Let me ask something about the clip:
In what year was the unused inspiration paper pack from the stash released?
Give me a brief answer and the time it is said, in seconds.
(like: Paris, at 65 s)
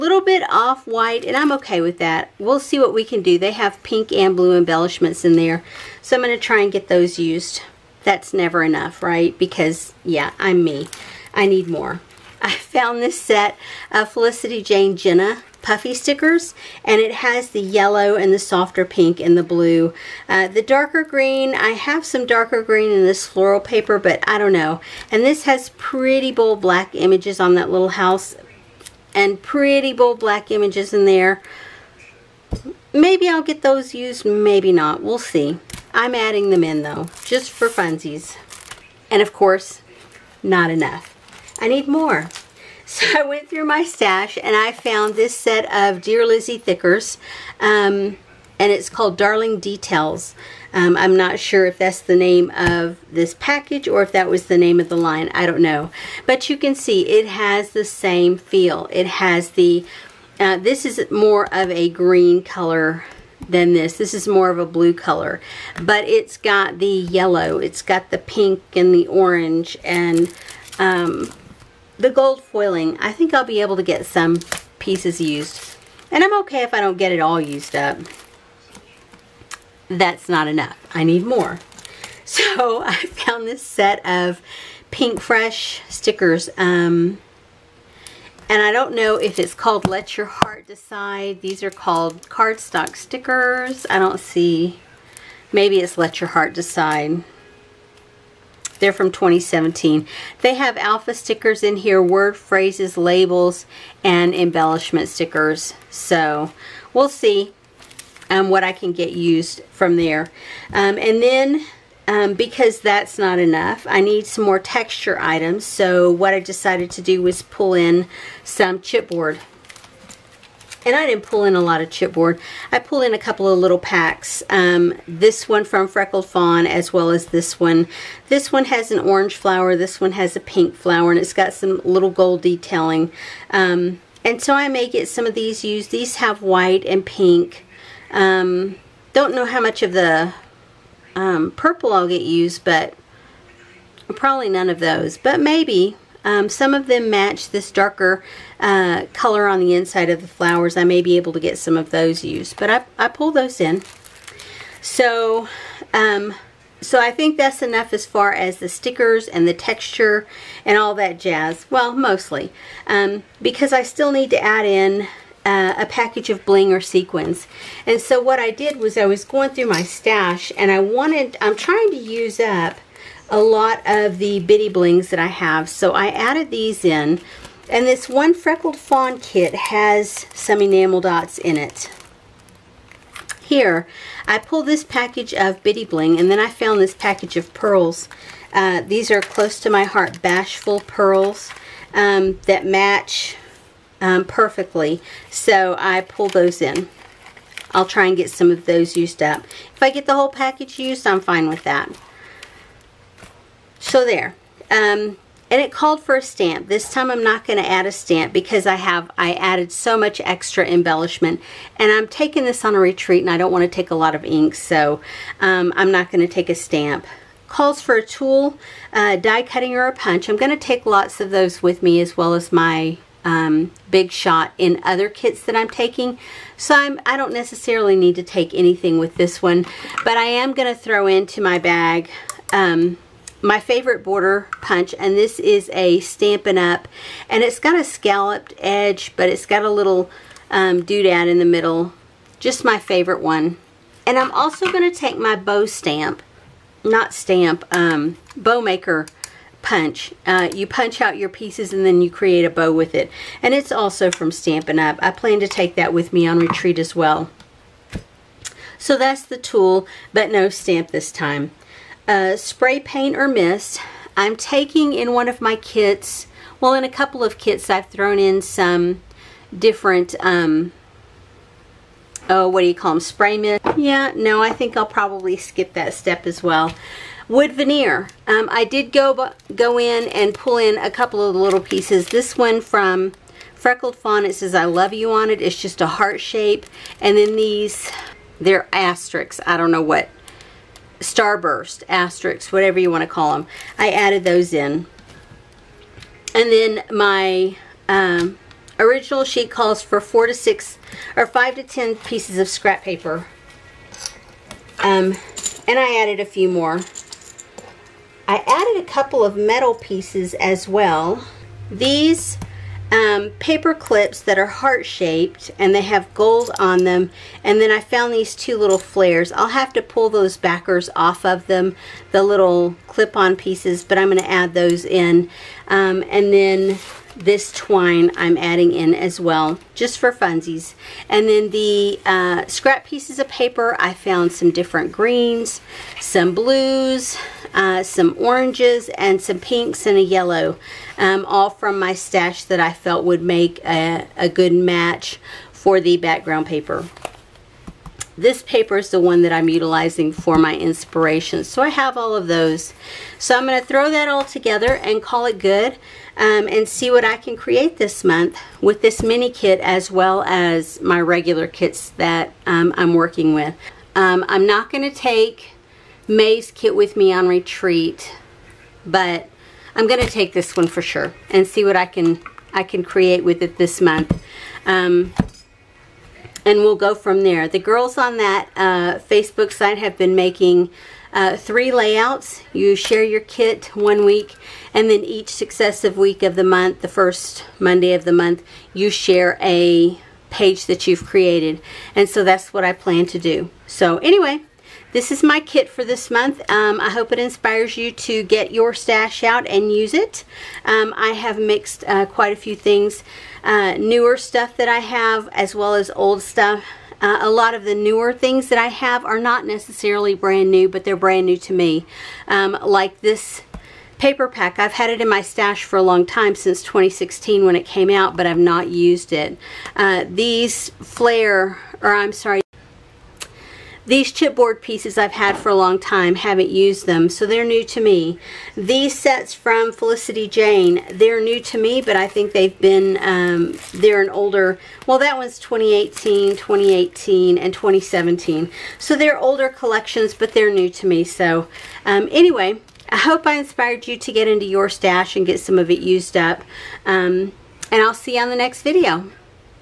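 2016, at 416 s.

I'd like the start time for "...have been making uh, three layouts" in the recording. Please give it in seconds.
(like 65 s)
379 s.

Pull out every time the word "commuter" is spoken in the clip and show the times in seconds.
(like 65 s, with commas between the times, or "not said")
not said.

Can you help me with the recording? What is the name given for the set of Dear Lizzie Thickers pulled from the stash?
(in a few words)
Darling Details.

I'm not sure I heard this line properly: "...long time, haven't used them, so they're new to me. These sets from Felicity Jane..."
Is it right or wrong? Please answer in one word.
right.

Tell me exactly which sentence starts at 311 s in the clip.
These um, paper clips that are heart-shaped and they have gold on them and then I found these two little flairs.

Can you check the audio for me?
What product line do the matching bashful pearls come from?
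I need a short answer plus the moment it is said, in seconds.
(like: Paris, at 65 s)
Close To My Heart, at 189 s.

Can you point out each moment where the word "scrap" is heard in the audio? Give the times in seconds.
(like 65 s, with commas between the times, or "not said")
302 s, 332 s.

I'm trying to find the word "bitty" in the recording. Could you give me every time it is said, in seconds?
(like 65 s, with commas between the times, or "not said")
174 s, 185 s.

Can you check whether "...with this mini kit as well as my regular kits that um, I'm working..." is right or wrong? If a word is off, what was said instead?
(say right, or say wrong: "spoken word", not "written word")
right.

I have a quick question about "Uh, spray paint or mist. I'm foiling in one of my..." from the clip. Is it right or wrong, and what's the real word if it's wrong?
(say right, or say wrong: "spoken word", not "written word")
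wrong: "taking", not "foiling".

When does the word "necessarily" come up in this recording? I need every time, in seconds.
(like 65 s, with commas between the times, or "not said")
227 s, 409 s.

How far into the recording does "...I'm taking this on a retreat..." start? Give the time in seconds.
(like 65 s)
211 s.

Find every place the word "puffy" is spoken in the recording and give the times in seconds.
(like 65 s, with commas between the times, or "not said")
15 s.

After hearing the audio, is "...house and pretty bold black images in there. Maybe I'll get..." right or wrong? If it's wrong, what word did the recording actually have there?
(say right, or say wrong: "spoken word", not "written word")
right.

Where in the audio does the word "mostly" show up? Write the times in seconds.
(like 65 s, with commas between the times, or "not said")
161 s.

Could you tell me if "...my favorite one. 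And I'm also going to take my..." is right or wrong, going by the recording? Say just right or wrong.
right.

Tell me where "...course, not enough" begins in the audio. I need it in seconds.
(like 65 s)
39 s.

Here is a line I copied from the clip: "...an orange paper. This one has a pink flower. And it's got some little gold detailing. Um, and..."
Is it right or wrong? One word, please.
wrong.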